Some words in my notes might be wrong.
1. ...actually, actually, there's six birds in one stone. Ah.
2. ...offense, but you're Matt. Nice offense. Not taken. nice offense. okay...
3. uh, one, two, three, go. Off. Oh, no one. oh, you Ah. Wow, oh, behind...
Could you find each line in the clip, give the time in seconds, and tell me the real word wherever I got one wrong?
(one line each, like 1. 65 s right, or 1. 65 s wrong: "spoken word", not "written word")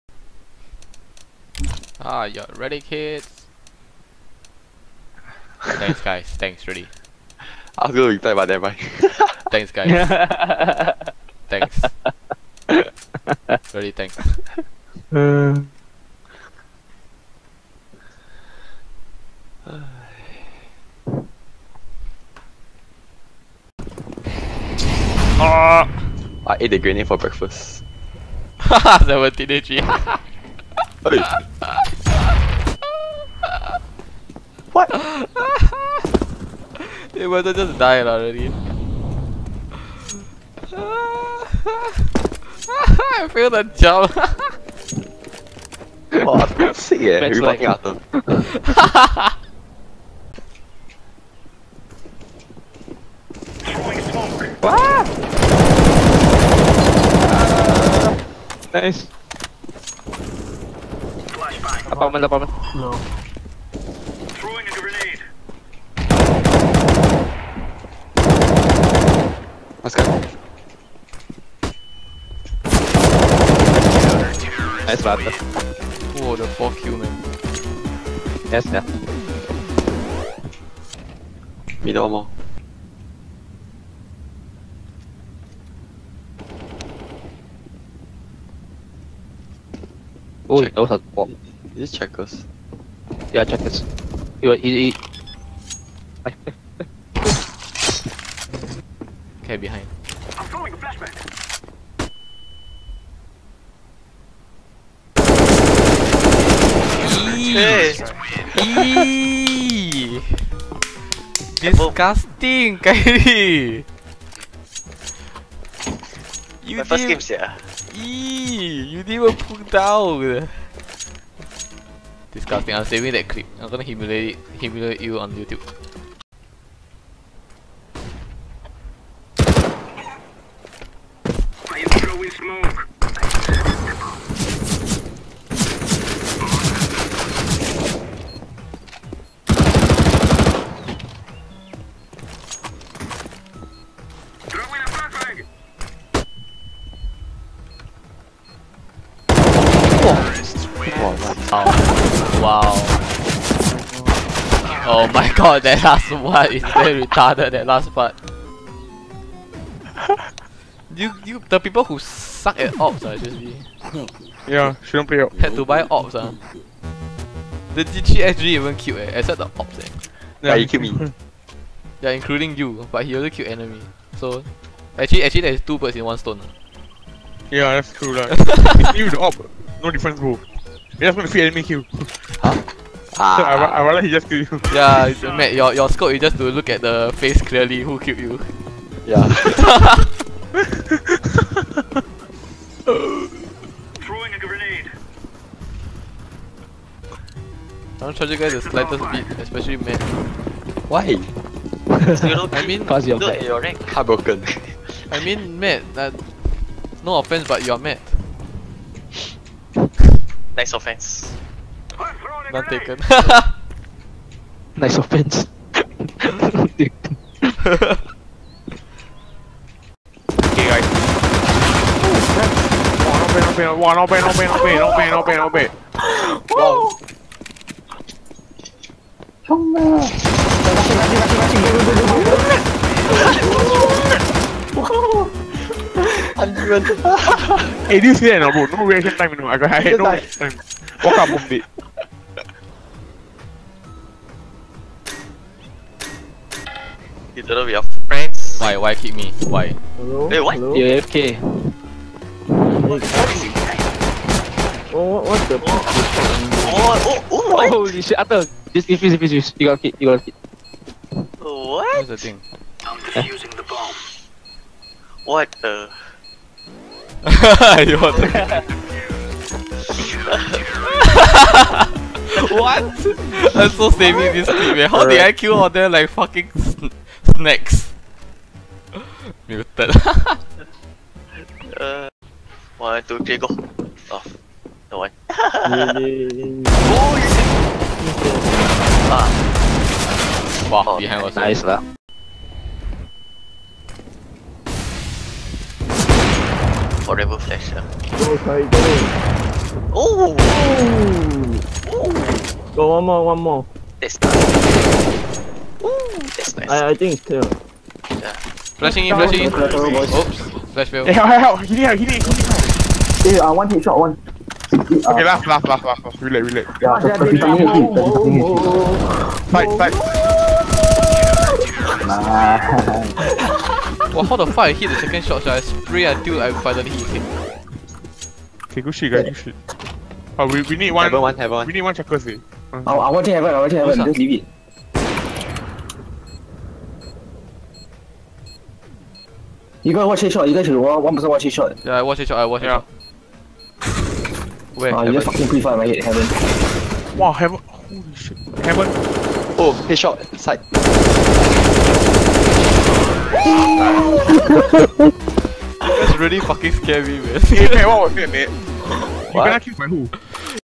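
1. 174 s wrong: "two", not "six"
2. 207 s right
3. 281 s right.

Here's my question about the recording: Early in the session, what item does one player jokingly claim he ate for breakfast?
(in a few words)
the grenade.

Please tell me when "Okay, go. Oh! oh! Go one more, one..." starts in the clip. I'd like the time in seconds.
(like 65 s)
298 s.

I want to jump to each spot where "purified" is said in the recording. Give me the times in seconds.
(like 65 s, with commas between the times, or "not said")
not said.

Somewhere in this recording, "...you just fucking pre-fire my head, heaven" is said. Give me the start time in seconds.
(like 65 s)
345 s.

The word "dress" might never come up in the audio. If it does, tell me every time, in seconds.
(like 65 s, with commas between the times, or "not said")
not said.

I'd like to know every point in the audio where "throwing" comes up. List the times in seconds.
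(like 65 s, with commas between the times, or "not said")
64 s, 100 s, 193 s.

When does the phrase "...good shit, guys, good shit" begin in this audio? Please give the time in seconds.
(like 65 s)
328 s.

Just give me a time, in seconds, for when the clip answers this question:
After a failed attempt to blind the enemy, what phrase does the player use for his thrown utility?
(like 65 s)
310 s.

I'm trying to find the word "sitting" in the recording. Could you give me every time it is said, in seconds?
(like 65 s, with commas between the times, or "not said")
not said.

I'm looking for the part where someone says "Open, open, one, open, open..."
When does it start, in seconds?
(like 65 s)
223 s.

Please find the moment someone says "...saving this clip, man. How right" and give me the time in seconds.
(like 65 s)
273 s.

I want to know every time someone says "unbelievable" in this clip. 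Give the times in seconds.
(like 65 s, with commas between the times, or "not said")
not said.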